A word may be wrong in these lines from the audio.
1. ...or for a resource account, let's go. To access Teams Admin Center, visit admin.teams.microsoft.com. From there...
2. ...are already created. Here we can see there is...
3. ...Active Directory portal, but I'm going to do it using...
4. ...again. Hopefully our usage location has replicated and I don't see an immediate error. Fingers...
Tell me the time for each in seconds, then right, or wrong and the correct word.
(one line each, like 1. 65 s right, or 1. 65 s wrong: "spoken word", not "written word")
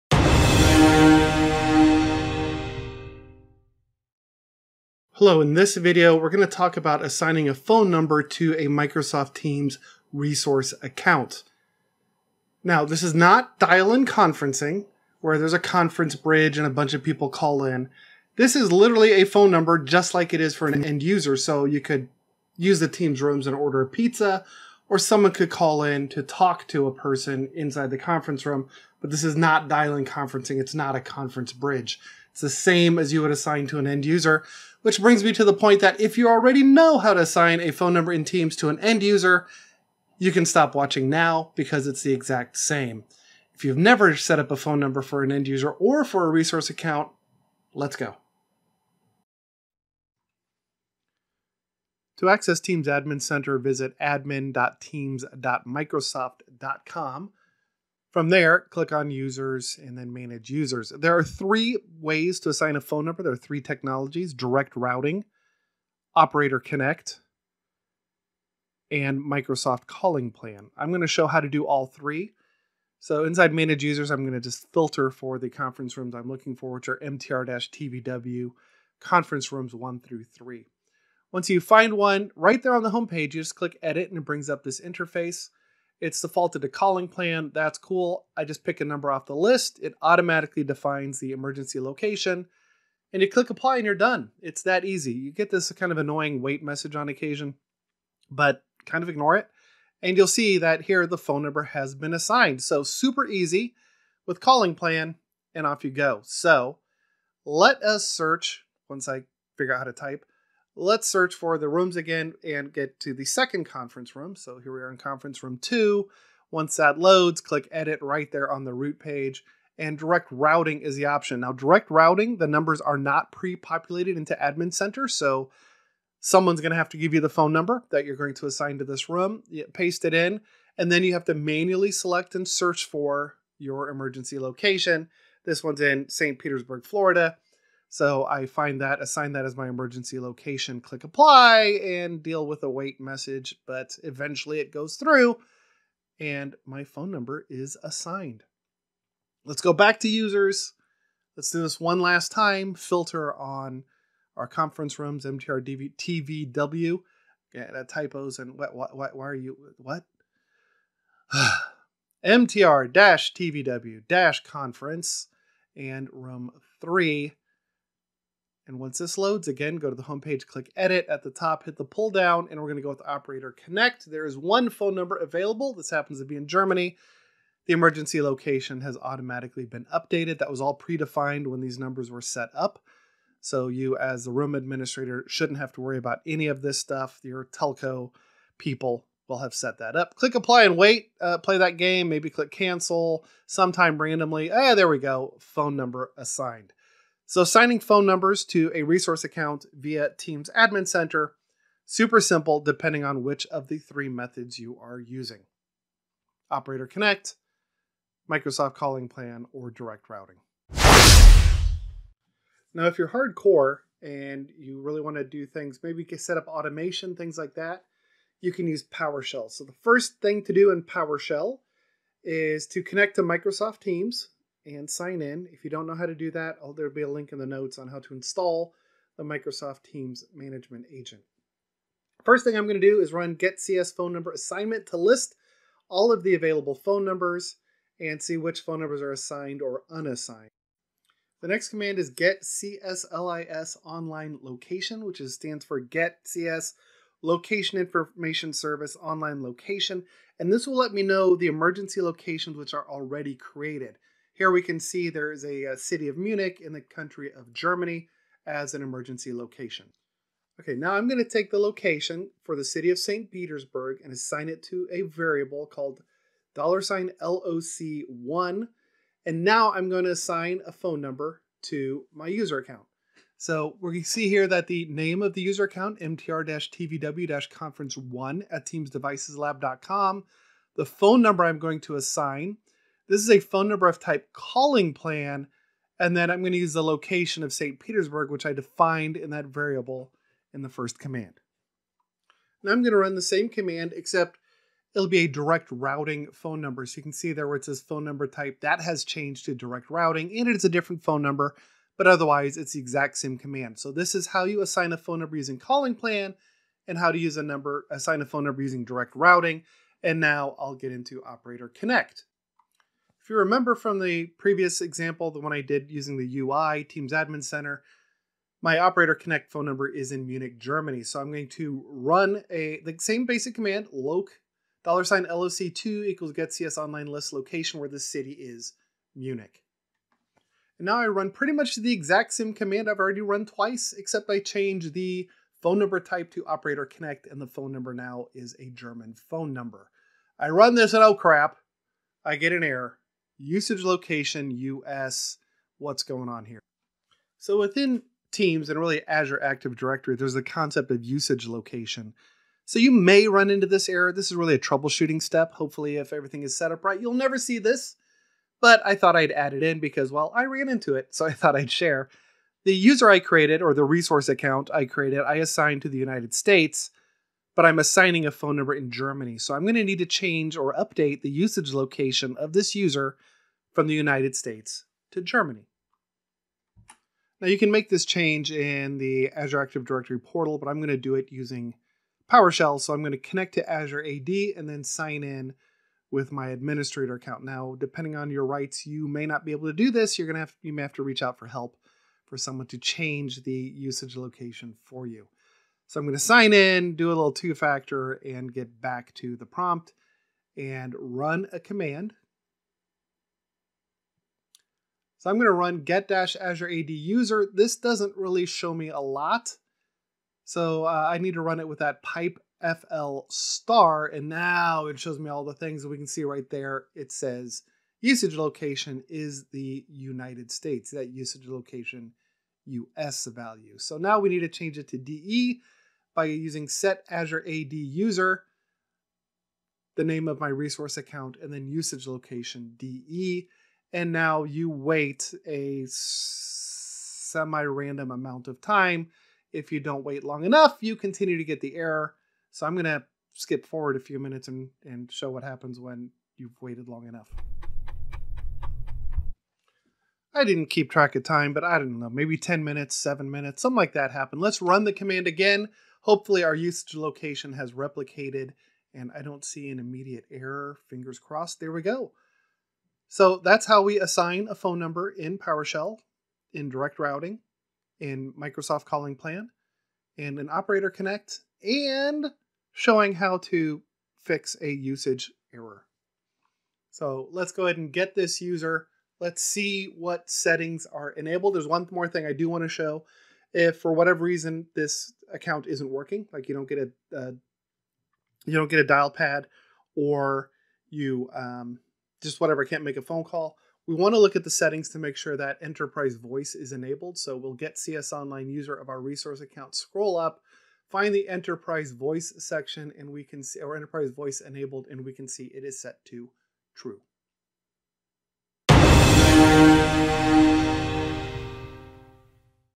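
1. 45 s right
2. 252 s right
3. 379 s right
4. 455 s right.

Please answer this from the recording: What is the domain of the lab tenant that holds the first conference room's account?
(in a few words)
teamsdevicesLab.com.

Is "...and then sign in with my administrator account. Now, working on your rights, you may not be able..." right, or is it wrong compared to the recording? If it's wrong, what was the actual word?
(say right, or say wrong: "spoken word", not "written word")
wrong: "depending", not "working".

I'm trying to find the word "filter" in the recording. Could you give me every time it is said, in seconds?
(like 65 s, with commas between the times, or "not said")
74 s, 152 s.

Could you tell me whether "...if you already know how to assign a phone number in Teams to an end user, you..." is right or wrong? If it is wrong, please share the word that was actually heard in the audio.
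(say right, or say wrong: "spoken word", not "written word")
right.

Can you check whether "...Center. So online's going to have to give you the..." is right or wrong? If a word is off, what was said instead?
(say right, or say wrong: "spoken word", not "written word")
wrong: "someone", not "online".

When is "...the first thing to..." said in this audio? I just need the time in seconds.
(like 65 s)
219 s.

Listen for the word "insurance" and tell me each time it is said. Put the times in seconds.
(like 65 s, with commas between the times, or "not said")
not said.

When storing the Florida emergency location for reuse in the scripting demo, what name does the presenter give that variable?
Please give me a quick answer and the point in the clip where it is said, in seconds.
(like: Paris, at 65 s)
$LOC1, at 266 s.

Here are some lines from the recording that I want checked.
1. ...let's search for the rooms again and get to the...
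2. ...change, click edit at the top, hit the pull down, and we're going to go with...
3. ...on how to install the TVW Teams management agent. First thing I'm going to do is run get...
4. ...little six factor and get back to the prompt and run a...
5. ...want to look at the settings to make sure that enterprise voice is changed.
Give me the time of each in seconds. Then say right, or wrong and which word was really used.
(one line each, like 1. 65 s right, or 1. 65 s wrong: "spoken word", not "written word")
1. 110 s right
2. 170 s wrong: "homepage", not "change"
3. 227 s wrong: "Microsoft", not "TVW"
4. 397 s wrong: "two", not "six"
5. 493 s wrong: "enabled", not "changed".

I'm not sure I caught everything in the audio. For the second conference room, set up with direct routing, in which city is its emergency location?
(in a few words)
St. Petersburg, Florida.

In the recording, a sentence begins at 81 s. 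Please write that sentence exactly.
Once you find one, right there on the homepage, you just click edit and it brings up this interface.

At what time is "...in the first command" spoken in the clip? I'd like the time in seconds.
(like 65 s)
290 s.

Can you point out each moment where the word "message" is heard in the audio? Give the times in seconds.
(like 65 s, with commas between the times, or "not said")
96 s, 143 s.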